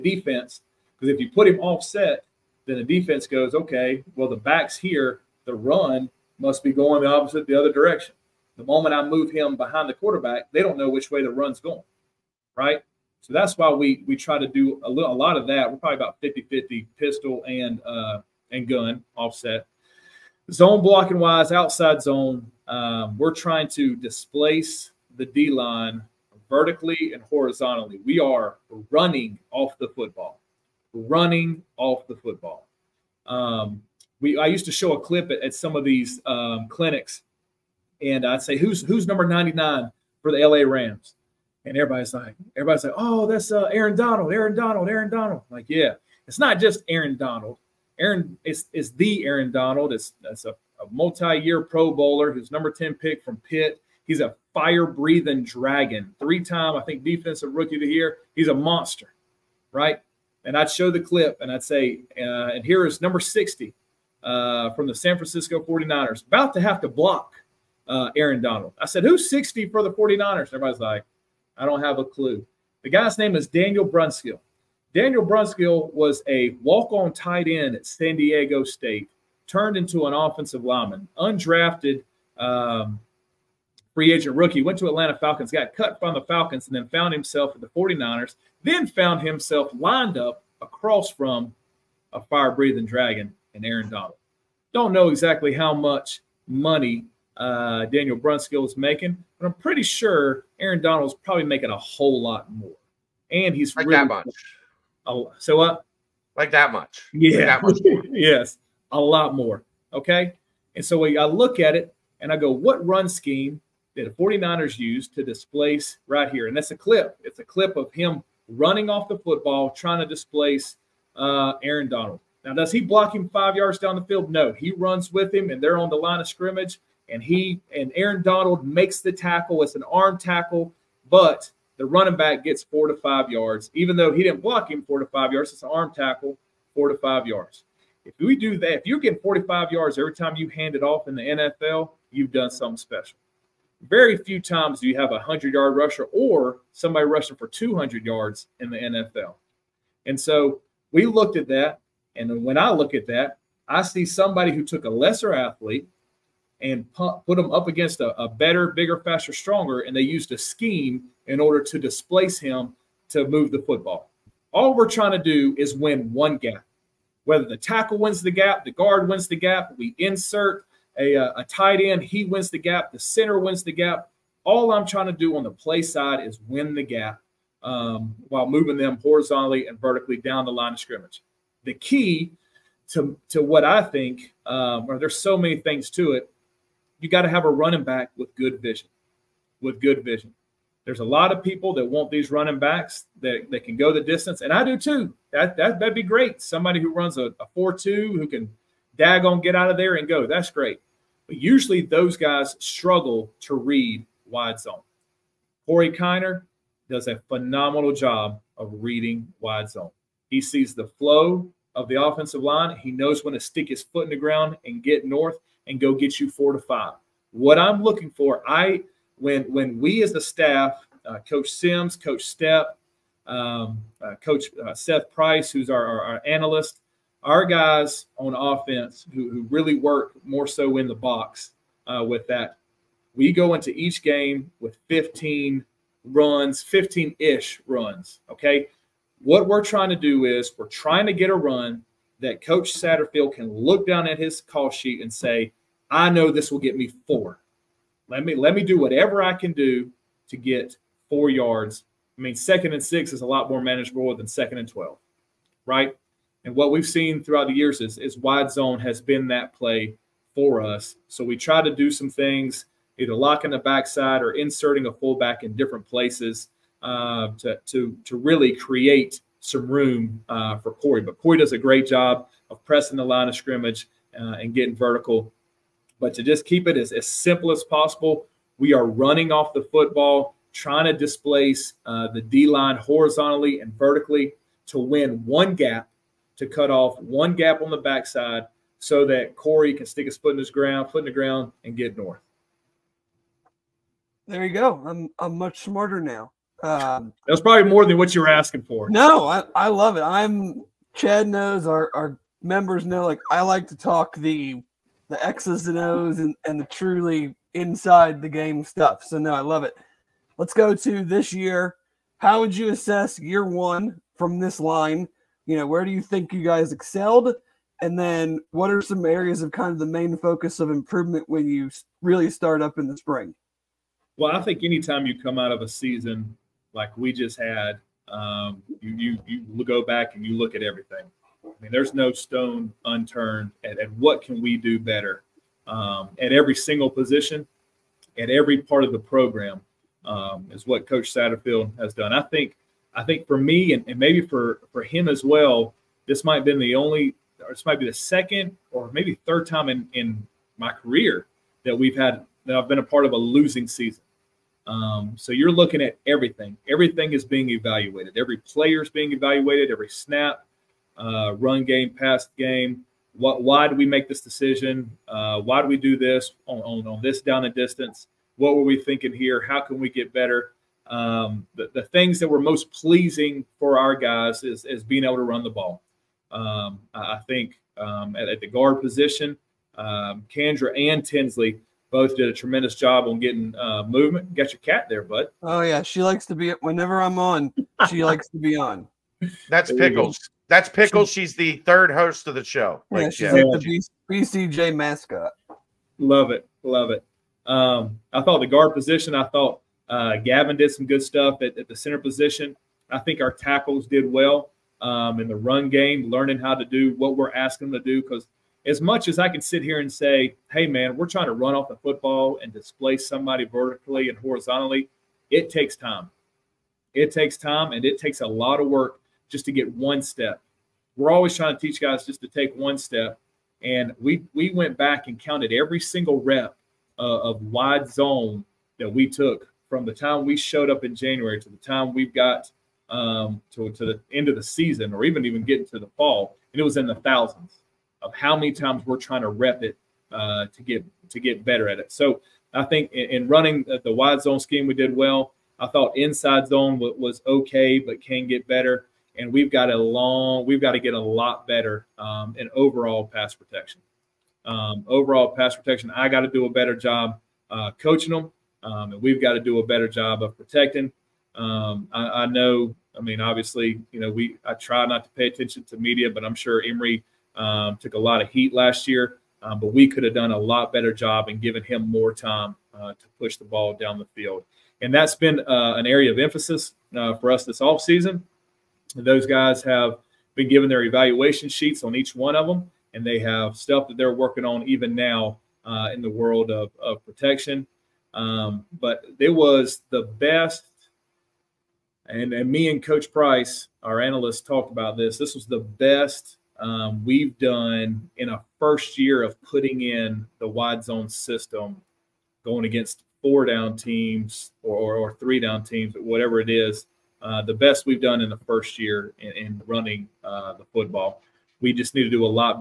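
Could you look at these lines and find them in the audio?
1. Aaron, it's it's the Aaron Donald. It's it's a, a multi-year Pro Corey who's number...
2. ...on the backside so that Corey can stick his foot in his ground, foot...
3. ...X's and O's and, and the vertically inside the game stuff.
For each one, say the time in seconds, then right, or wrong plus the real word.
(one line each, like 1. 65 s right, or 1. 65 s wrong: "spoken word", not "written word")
1. 47 s wrong: "Bowler", not "Corey"
2. 287 s right
3. 305 s wrong: "truly", not "vertically".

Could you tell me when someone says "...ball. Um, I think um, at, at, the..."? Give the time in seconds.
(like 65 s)
375 s.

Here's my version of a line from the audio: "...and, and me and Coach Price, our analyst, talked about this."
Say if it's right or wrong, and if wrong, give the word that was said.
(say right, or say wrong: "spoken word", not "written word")
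right.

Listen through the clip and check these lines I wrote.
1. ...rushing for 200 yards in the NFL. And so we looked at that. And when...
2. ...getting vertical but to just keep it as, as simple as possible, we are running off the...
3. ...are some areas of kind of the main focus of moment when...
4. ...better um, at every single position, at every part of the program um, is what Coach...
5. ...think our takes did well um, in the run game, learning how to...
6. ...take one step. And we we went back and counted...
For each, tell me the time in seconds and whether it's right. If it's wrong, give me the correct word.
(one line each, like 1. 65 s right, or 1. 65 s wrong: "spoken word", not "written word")
1. 147 s right
2. 274 s right
3. 318 s wrong: "improvement", not "moment"
4. 334 s right
5. 402 s wrong: "tackles", not "takes"
6. 422 s right.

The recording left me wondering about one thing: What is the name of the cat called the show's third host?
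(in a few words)
Pickle.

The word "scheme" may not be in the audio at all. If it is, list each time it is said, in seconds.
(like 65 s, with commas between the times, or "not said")
113 s, 160 s, 444 s.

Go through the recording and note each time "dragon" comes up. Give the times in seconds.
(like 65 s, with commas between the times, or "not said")
55 s, 92 s.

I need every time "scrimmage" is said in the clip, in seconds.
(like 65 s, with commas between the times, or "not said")
126 s, 180 s, 273 s.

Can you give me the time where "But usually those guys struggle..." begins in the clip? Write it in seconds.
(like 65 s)
201 s.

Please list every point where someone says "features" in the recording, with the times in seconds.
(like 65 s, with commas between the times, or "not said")
not said.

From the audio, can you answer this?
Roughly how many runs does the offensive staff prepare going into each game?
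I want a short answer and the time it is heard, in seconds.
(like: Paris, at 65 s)
15, at 236 s.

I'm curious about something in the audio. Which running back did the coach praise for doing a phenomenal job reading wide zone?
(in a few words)
Corey Kiner.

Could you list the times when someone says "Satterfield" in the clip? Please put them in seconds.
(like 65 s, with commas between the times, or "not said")
242 s, 341 s.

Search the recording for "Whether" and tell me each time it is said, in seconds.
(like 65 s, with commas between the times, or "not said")
167 s.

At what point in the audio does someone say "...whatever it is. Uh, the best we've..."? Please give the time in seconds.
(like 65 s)
505 s.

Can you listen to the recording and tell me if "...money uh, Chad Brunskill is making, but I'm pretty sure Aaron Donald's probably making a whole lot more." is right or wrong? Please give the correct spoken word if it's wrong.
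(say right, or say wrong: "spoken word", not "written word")
wrong: "Daniel", not "Chad".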